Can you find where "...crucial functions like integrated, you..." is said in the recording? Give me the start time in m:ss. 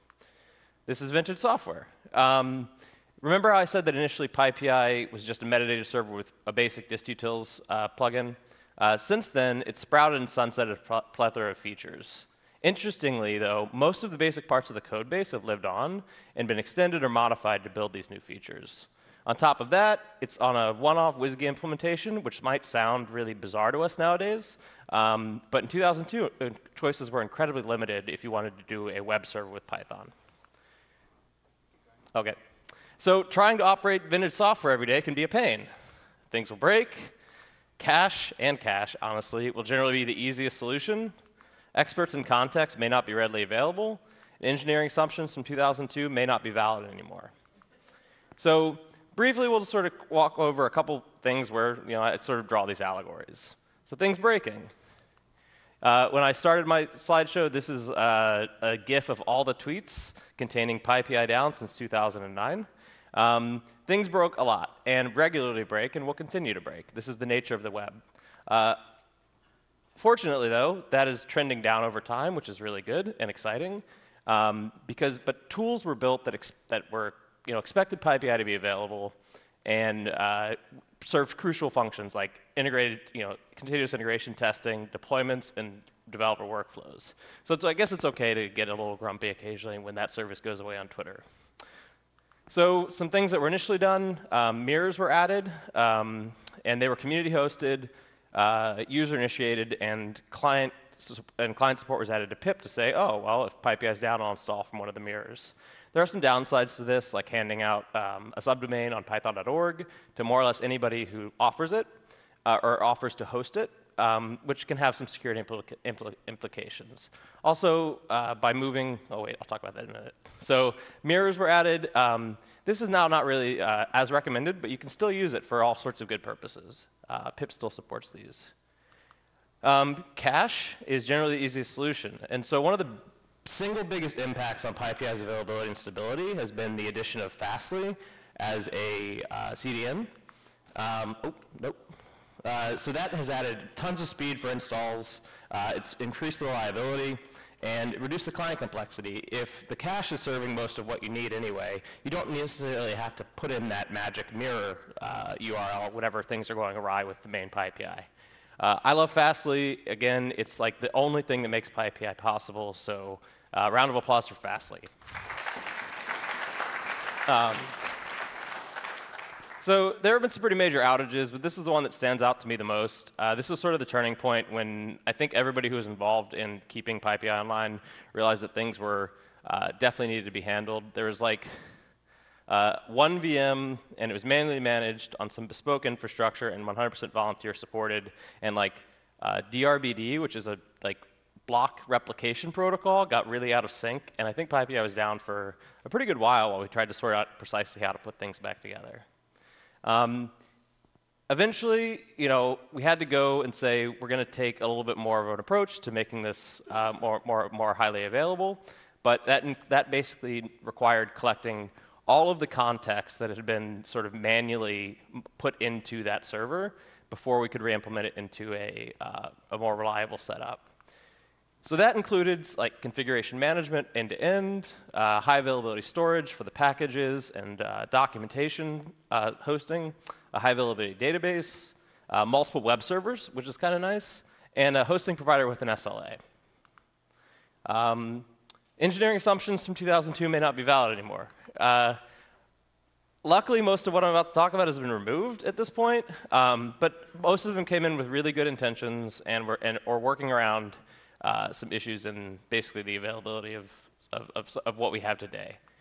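1:21.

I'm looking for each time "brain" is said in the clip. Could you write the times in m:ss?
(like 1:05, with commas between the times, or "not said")
not said.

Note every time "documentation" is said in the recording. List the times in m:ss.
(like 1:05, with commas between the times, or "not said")
3:47.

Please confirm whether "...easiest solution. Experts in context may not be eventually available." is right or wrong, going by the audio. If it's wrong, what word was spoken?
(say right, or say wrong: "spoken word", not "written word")
wrong: "readily", not "eventually".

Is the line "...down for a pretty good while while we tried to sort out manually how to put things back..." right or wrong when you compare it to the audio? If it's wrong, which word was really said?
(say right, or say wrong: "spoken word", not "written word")
wrong: "precisely", not "manually".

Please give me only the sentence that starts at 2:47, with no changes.
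Um, so there have been some pretty major outages, but this is the one that stands out to me the most.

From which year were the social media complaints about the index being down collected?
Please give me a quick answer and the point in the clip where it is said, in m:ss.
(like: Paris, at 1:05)
2009, at 1:01.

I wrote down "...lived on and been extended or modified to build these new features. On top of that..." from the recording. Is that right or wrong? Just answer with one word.
right.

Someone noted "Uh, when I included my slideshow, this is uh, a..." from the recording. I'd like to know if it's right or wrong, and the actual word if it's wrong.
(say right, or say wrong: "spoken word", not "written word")
wrong: "started", not "included".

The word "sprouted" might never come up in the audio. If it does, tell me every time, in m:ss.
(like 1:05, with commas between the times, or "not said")
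0:09.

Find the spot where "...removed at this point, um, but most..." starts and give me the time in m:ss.
4:04.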